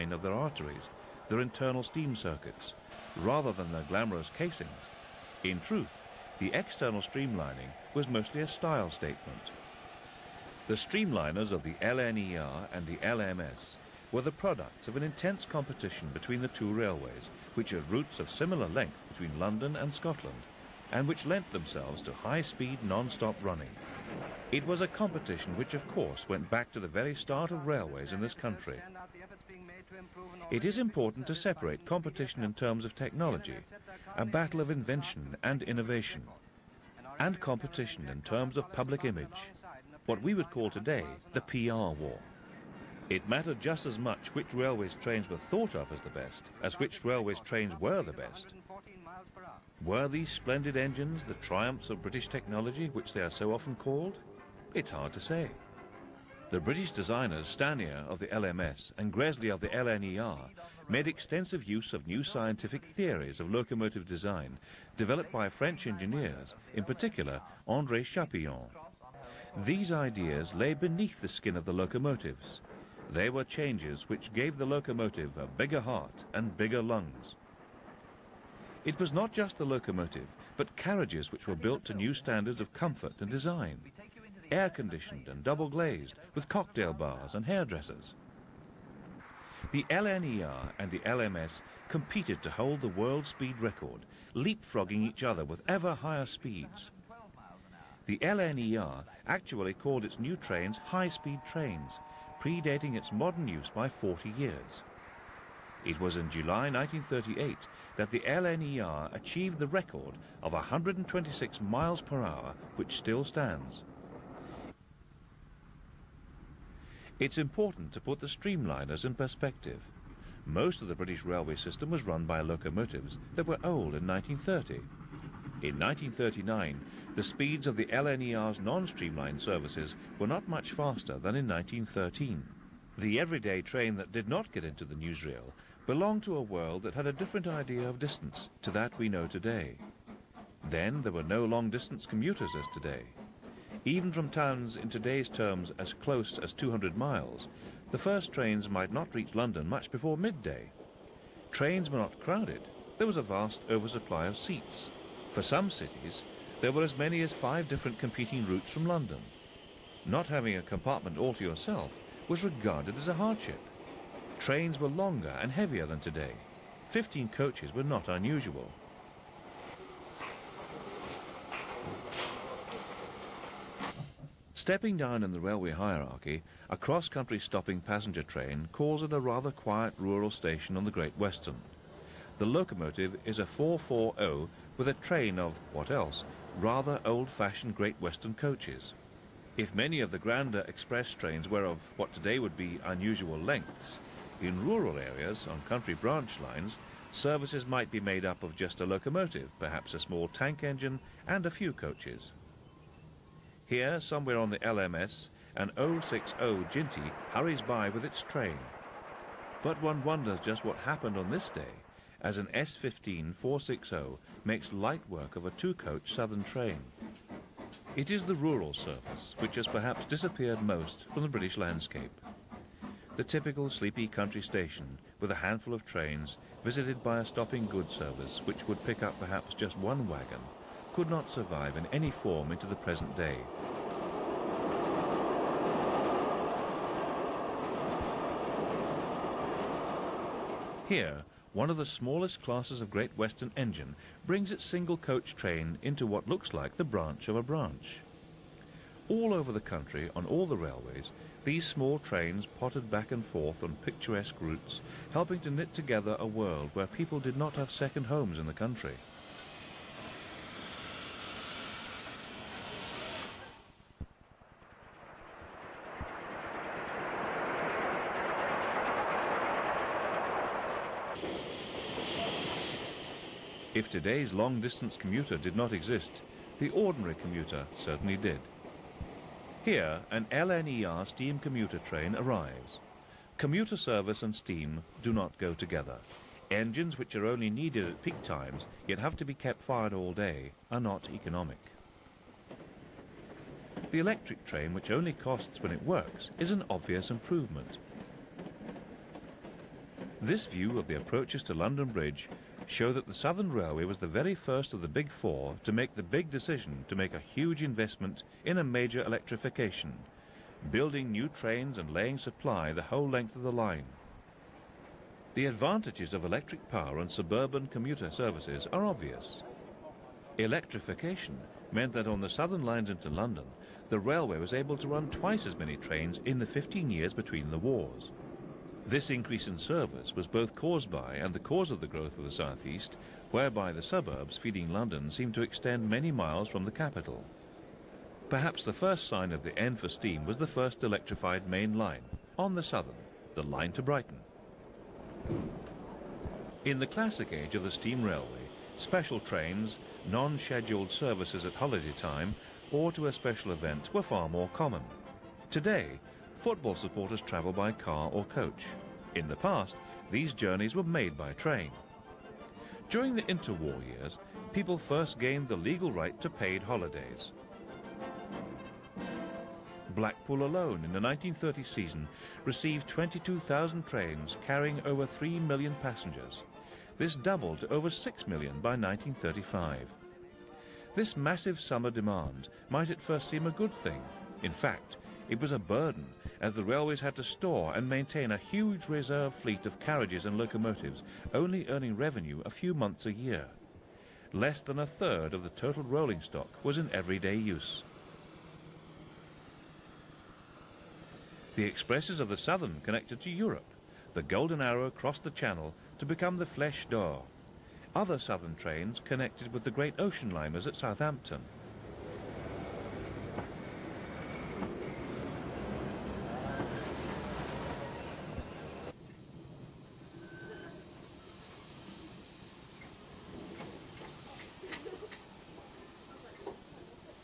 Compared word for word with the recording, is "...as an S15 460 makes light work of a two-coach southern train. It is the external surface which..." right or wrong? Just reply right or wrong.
wrong.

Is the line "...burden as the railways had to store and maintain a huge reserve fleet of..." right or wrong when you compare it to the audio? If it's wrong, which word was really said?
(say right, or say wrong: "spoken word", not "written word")
right.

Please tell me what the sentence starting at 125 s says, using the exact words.
In 1939, the speeds of the LNER's non-streamlined services were not much faster than in 1913.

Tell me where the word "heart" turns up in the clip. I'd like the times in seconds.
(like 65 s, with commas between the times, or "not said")
75 s.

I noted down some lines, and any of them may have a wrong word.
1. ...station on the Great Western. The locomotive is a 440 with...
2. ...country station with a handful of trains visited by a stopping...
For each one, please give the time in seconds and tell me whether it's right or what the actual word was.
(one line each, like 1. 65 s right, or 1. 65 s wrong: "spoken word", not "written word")
1. 180 s right
2. 224 s right.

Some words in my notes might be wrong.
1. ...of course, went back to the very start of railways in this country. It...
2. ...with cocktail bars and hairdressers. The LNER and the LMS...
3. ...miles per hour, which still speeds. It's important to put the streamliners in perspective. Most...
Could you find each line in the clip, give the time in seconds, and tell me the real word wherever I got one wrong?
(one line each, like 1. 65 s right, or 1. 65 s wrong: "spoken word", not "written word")
1. 25 s right
2. 86 s right
3. 111 s wrong: "stands", not "speeds".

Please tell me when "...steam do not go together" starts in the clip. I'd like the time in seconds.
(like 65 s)
284 s.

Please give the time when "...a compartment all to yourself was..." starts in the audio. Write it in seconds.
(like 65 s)
160 s.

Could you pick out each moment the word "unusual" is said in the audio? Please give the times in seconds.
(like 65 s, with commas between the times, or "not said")
168 s, 192 s.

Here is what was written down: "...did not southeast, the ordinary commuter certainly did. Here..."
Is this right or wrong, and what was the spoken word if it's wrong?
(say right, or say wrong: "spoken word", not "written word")
wrong: "exist", not "southeast".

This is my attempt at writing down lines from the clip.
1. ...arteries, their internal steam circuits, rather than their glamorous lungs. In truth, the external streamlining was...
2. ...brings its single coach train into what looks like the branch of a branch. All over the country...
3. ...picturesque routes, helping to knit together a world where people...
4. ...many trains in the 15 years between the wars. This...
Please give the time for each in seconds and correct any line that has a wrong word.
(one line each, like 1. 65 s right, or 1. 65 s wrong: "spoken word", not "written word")
1. 0 s wrong: "casings", not "lungs"
2. 244 s right
3. 253 s right
4. 325 s right.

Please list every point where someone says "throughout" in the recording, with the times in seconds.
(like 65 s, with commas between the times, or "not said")
not said.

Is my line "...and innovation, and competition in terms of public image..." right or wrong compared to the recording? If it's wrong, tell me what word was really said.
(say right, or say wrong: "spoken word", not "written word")
right.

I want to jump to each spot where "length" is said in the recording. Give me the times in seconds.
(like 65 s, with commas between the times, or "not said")
18 s, 193 s, 313 s.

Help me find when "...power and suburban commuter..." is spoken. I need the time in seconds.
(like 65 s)
316 s.